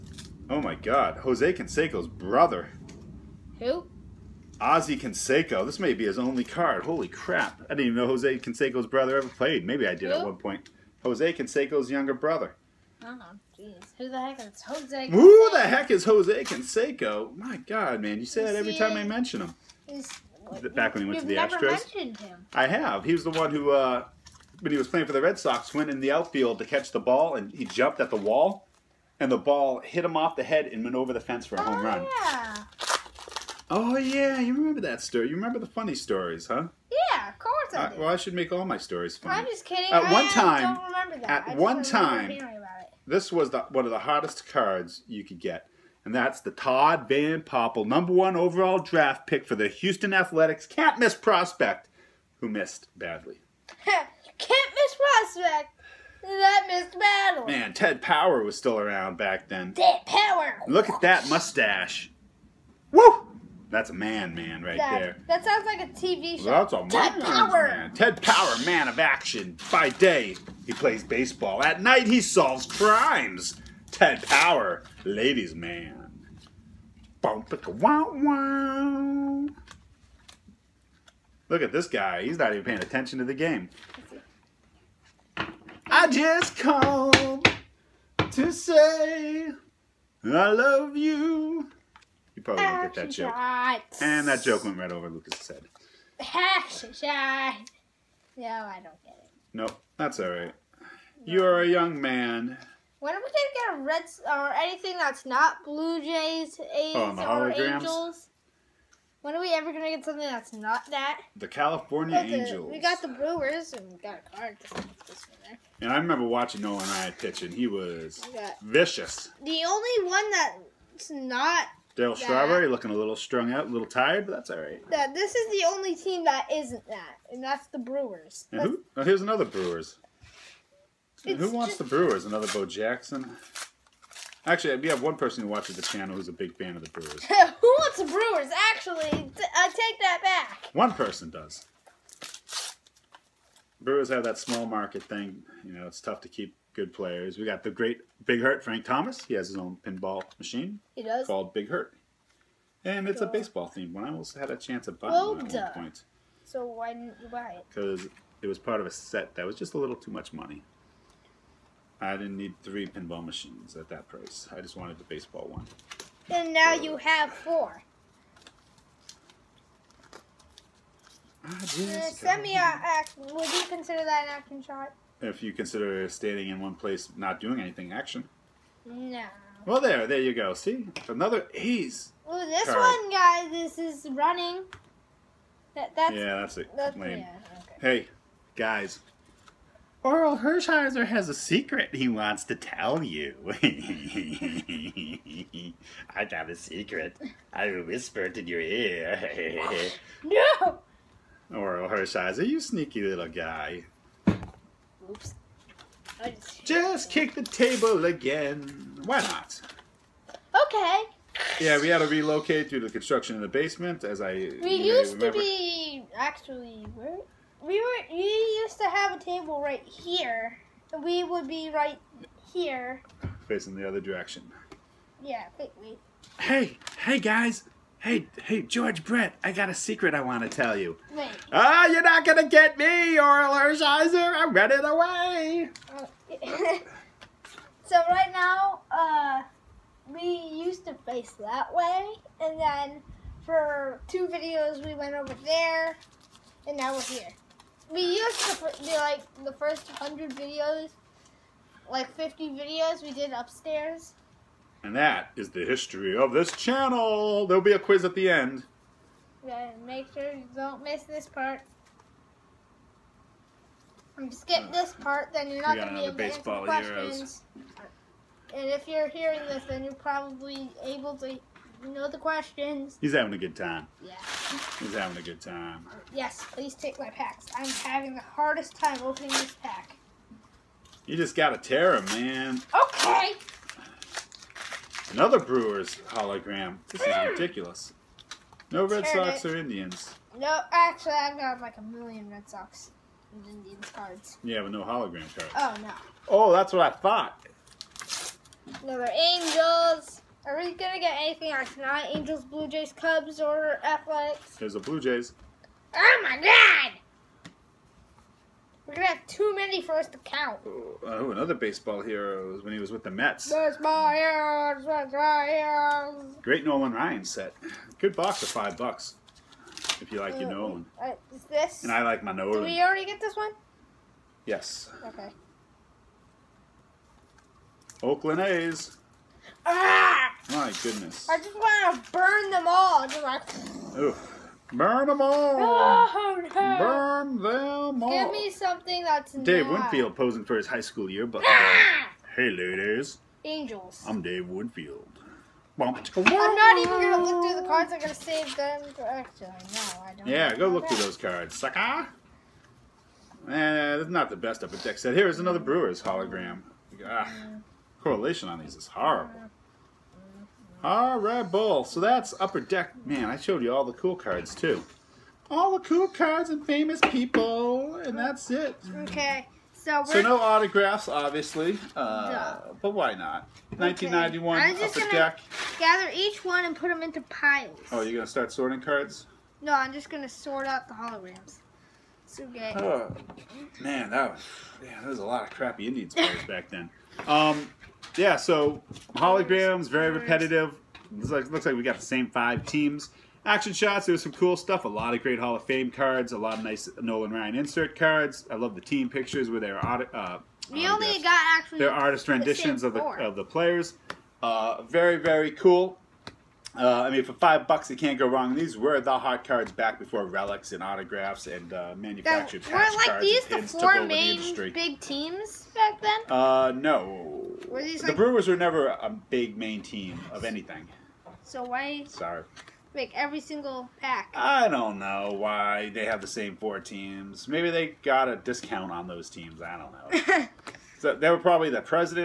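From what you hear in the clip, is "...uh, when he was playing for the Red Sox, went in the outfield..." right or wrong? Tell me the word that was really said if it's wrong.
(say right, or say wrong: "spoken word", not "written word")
right.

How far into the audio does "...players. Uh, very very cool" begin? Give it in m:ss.
6:43.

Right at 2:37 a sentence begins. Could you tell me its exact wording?
Because it was part of a set that was just a little too much money.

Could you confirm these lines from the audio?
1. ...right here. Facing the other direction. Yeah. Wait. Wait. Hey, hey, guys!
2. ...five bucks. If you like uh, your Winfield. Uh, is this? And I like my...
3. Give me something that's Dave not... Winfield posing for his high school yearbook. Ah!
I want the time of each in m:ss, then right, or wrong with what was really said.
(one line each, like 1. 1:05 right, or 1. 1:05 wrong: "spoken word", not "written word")
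1. 3:41 right
2. 5:18 wrong: "Nolan", not "Winfield"
3. 5:38 right.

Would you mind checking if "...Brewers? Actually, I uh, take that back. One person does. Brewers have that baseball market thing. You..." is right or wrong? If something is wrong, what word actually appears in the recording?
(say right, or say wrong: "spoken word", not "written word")
wrong: "small", not "baseball".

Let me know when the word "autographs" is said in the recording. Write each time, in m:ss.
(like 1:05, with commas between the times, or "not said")
6:10, 6:50.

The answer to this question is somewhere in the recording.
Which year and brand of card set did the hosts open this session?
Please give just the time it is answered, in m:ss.
6:13.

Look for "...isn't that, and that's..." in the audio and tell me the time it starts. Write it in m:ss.
2:06.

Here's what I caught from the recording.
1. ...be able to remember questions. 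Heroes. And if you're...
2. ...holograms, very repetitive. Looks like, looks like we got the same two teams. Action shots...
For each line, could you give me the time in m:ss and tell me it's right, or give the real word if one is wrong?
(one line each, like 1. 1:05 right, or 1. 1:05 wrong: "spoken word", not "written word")
1. 4:25 wrong: "answer", not "remember"
2. 6:29 wrong: "five", not "two".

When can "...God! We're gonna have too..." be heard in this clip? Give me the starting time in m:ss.
5:06.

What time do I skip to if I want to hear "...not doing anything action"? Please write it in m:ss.
2:57.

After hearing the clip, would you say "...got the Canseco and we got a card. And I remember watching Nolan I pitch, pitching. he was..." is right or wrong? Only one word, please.
wrong.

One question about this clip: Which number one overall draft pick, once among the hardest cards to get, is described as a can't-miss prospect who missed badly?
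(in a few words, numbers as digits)
Todd Van Poppel.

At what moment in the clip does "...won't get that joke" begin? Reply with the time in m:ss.
1:32.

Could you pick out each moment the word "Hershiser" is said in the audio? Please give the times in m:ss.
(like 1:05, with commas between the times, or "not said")
3:10, 3:21, 3:53.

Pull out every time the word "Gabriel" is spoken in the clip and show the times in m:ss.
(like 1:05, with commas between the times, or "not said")
not said.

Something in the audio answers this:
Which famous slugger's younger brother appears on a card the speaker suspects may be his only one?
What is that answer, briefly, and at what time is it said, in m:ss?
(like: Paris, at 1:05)
Ozzie Canseco, at 0:04.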